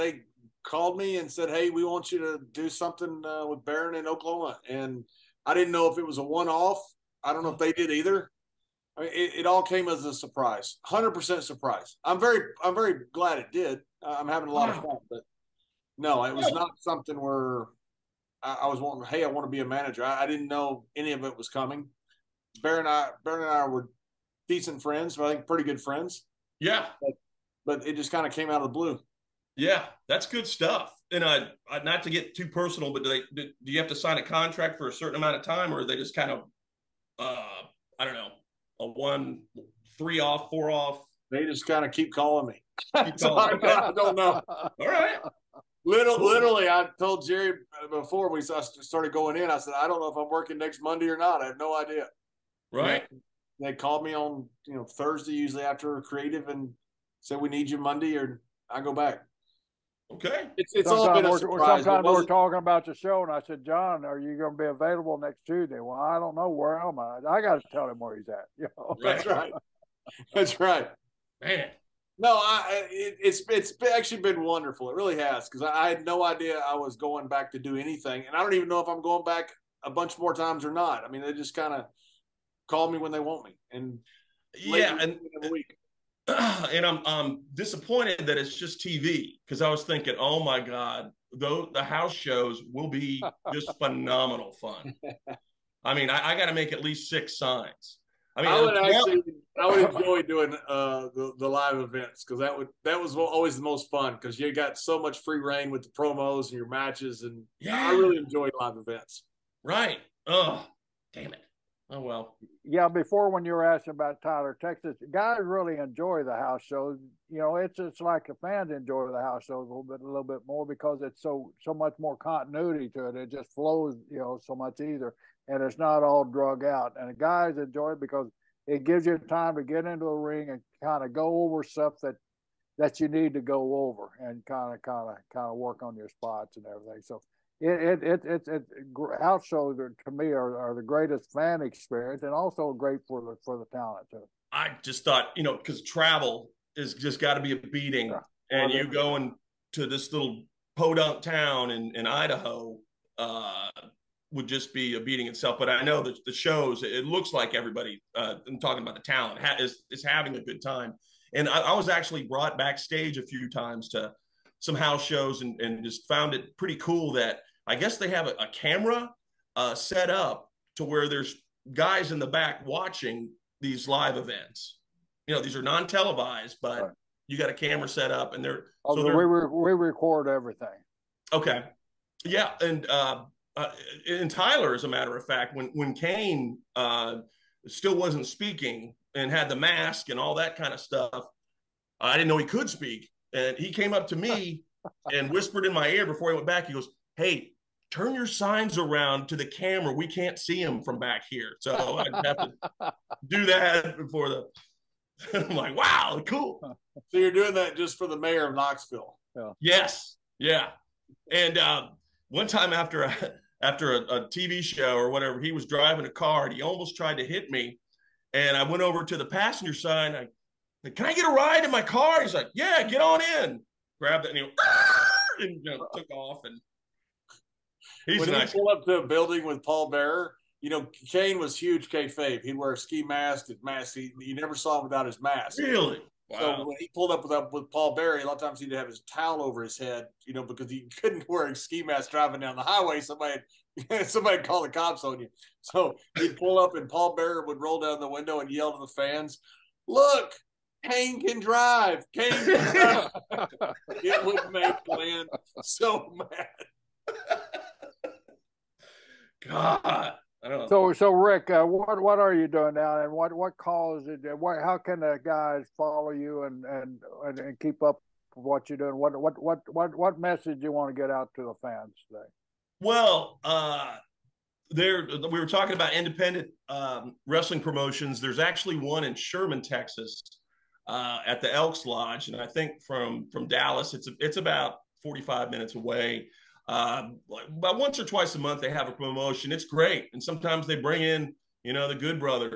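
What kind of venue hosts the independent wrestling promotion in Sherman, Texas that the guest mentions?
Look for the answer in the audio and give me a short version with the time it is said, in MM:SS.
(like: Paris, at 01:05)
Elks Lodge, at 04:41.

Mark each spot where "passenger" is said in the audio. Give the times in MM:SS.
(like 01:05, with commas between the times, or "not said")
03:39.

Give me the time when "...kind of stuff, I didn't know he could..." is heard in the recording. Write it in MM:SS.
03:10.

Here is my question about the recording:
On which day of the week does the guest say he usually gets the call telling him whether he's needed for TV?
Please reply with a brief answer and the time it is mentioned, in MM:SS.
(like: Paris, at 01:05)
Thursday, at 00:54.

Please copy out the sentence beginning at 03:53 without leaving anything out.
He, you never saw him without his mask.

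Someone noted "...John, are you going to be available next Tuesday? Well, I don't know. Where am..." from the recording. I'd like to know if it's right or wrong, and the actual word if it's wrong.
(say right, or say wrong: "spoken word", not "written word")
right.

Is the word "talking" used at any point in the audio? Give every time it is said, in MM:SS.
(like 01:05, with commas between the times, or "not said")
01:02, 02:38, 04:35.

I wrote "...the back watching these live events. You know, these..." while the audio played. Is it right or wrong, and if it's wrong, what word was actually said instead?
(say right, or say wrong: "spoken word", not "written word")
right.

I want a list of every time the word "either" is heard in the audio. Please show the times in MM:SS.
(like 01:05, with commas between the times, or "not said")
00:07, 02:04.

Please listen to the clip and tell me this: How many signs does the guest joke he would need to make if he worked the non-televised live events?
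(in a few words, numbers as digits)
6.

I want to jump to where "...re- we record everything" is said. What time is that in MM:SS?
02:59.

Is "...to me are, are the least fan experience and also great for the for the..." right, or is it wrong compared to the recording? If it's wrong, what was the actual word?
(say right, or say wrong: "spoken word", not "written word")
wrong: "greatest", not "least".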